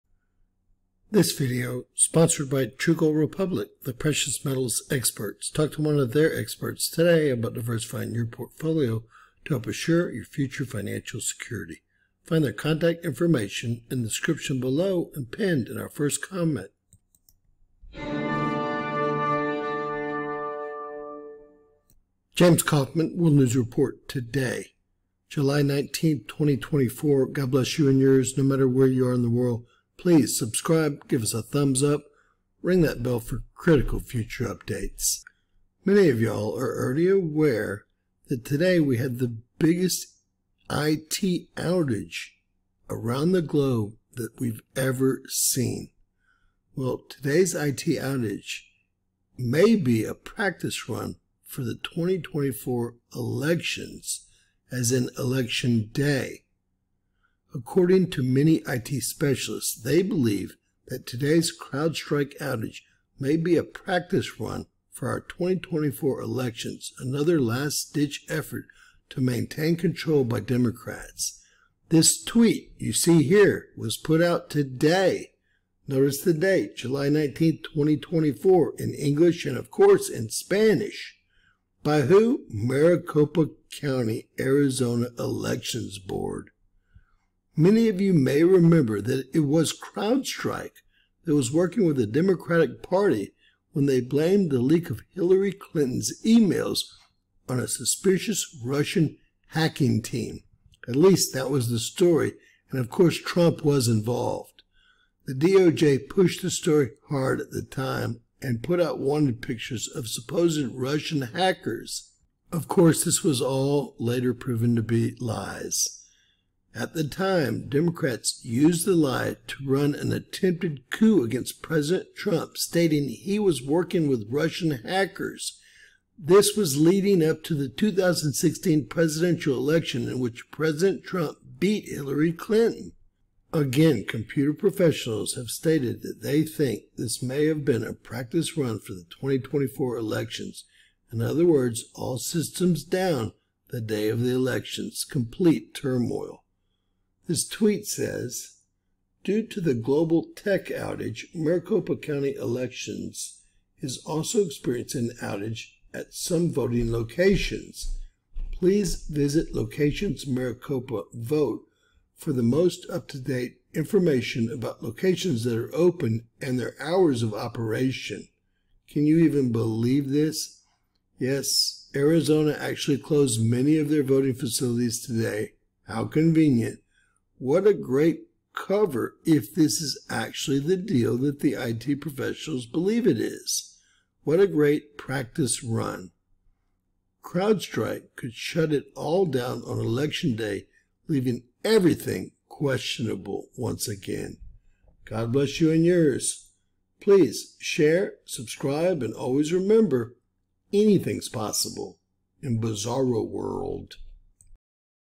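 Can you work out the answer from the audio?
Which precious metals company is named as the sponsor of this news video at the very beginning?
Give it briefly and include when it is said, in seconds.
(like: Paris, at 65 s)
True Gold Republic, at 2 s.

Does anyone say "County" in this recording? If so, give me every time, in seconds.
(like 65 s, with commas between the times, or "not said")
83 s, 151 s.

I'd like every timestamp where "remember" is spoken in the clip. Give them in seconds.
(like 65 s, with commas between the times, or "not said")
88 s, 199 s.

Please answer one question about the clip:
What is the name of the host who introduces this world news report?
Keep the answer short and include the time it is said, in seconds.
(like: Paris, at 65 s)
James Kaufman, at 22 s.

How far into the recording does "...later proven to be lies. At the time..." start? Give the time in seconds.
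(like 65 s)
113 s.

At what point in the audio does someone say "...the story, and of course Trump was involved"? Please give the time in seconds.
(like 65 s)
101 s.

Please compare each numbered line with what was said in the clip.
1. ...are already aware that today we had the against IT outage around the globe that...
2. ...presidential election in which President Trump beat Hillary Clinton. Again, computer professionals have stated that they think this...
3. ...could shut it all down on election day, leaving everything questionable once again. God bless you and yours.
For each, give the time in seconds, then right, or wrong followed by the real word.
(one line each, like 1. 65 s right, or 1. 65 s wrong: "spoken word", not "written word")
1. 36 s wrong: "biggest", not "against"
2. 128 s right
3. 188 s right.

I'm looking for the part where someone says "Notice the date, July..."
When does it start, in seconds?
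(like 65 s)
75 s.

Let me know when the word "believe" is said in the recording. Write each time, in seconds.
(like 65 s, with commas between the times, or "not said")
60 s, 169 s, 182 s.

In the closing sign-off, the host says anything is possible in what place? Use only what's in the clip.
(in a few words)
Bizarro World.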